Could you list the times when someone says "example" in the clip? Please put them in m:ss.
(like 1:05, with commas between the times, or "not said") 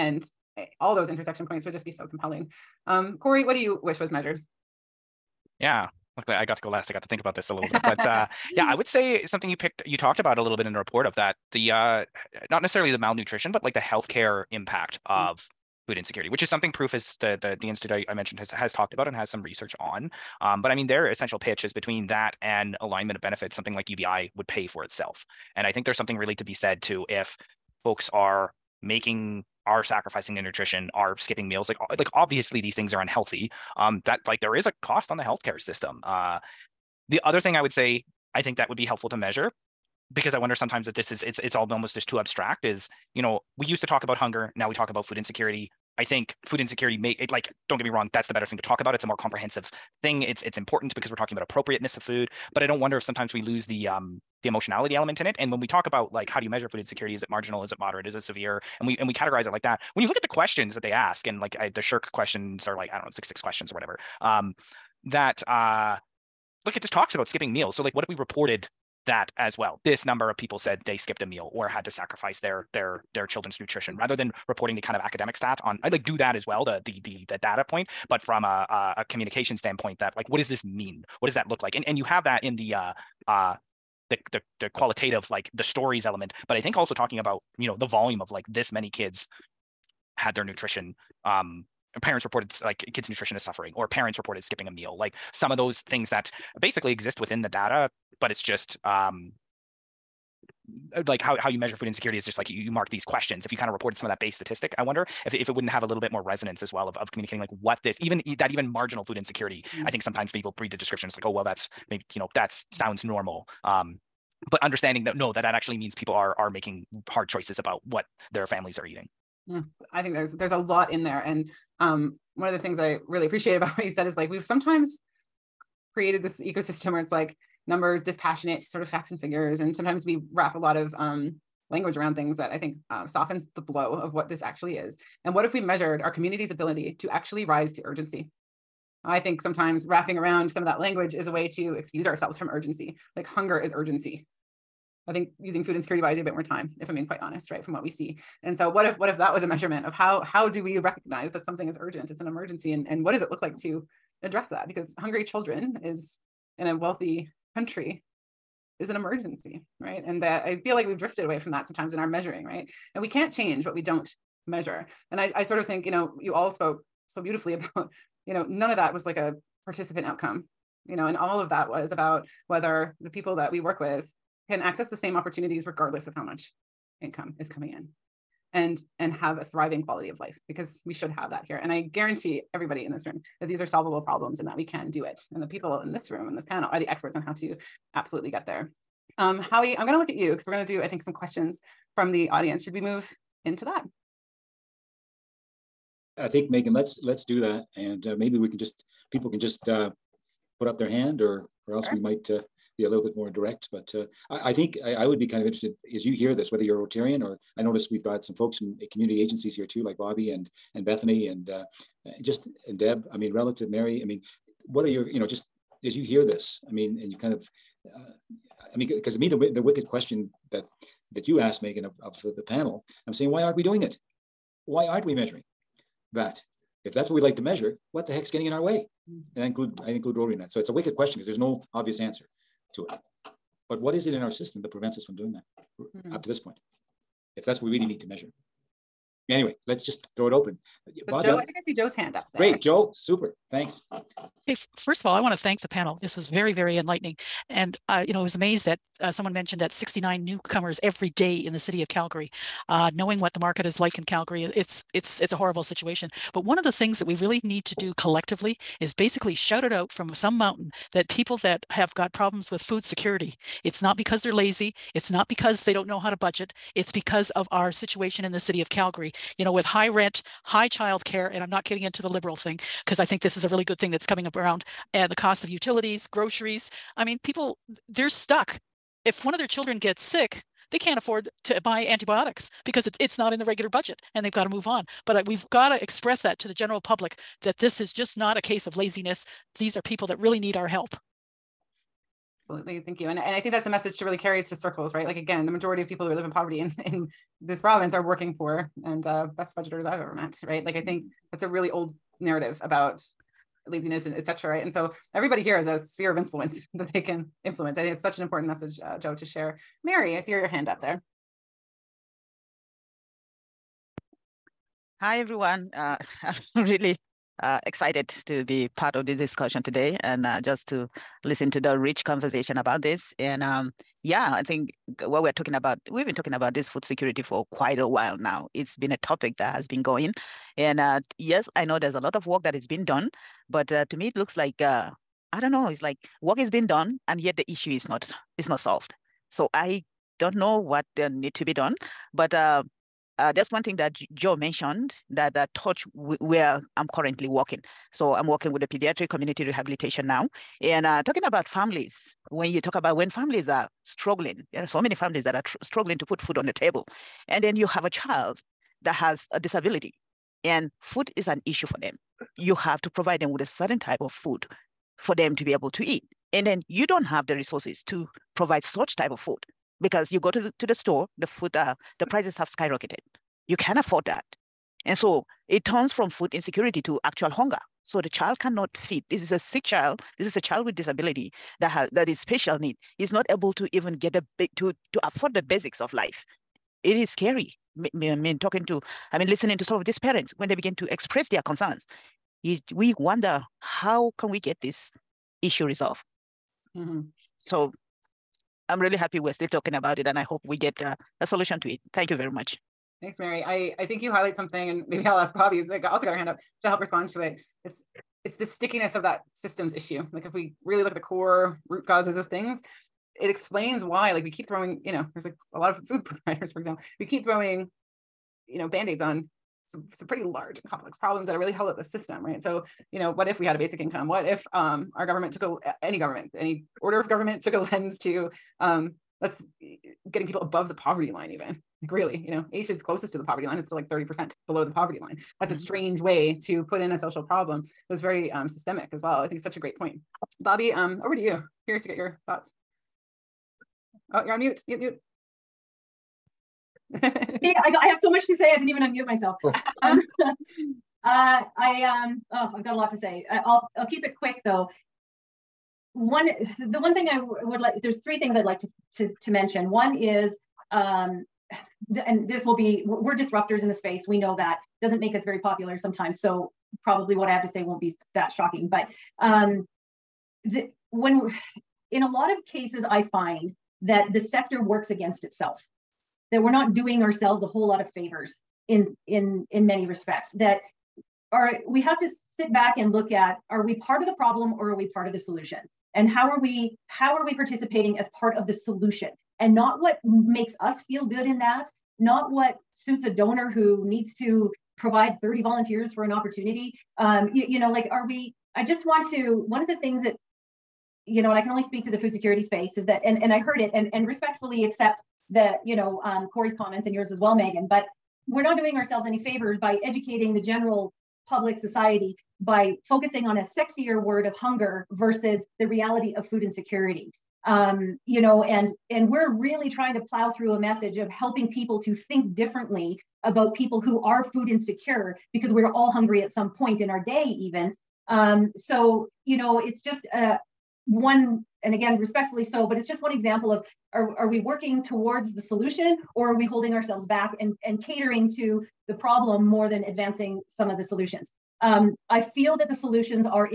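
6:56, 8:53.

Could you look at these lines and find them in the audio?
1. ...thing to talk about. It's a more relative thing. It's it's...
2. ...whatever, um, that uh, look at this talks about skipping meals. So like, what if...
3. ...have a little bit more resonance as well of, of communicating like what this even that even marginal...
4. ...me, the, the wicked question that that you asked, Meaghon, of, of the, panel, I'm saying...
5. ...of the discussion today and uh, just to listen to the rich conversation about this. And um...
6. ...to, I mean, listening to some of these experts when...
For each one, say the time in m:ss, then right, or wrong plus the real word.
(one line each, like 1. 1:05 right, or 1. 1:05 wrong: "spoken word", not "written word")
1. 0:48 wrong: "comprehensive", not "relative"
2. 1:03 right
3. 1:45 right
4. 3:39 right
5. 5:18 right
6. 6:28 wrong: "parents", not "experts".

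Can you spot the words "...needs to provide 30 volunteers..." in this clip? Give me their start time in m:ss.
8:13.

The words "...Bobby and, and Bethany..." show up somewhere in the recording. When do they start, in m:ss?
3:29.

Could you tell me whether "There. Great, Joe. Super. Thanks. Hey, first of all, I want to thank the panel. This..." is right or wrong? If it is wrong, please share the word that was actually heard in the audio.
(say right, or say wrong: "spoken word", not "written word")
right.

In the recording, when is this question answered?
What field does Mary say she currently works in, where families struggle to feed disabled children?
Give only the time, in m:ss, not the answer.
5:48.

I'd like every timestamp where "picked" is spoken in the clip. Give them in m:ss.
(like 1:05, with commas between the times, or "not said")
0:09.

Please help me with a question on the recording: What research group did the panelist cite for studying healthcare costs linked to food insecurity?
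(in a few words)
Proof.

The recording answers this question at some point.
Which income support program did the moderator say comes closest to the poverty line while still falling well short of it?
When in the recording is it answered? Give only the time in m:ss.
7:12.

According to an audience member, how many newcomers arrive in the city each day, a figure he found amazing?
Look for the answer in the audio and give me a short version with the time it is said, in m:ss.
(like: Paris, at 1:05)
69, at 4:09.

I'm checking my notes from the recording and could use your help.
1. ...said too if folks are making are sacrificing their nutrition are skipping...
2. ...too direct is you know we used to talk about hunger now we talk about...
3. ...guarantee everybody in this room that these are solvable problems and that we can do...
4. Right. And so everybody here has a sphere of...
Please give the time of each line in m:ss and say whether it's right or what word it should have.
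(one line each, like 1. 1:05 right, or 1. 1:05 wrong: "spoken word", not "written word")
1. 0:26 right
2. 0:42 wrong: "abstract", not "direct"
3. 3:01 right
4. 5:04 right.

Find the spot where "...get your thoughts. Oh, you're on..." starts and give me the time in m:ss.
7:21.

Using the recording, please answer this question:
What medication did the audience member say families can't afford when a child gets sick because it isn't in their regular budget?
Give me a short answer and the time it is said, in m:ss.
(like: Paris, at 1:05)
antibiotics, at 4:41.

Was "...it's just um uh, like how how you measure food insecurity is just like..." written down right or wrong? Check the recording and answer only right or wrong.
right.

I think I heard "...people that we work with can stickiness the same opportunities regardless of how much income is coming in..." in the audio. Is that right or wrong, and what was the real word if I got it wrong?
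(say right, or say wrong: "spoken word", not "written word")
wrong: "access", not "stickiness".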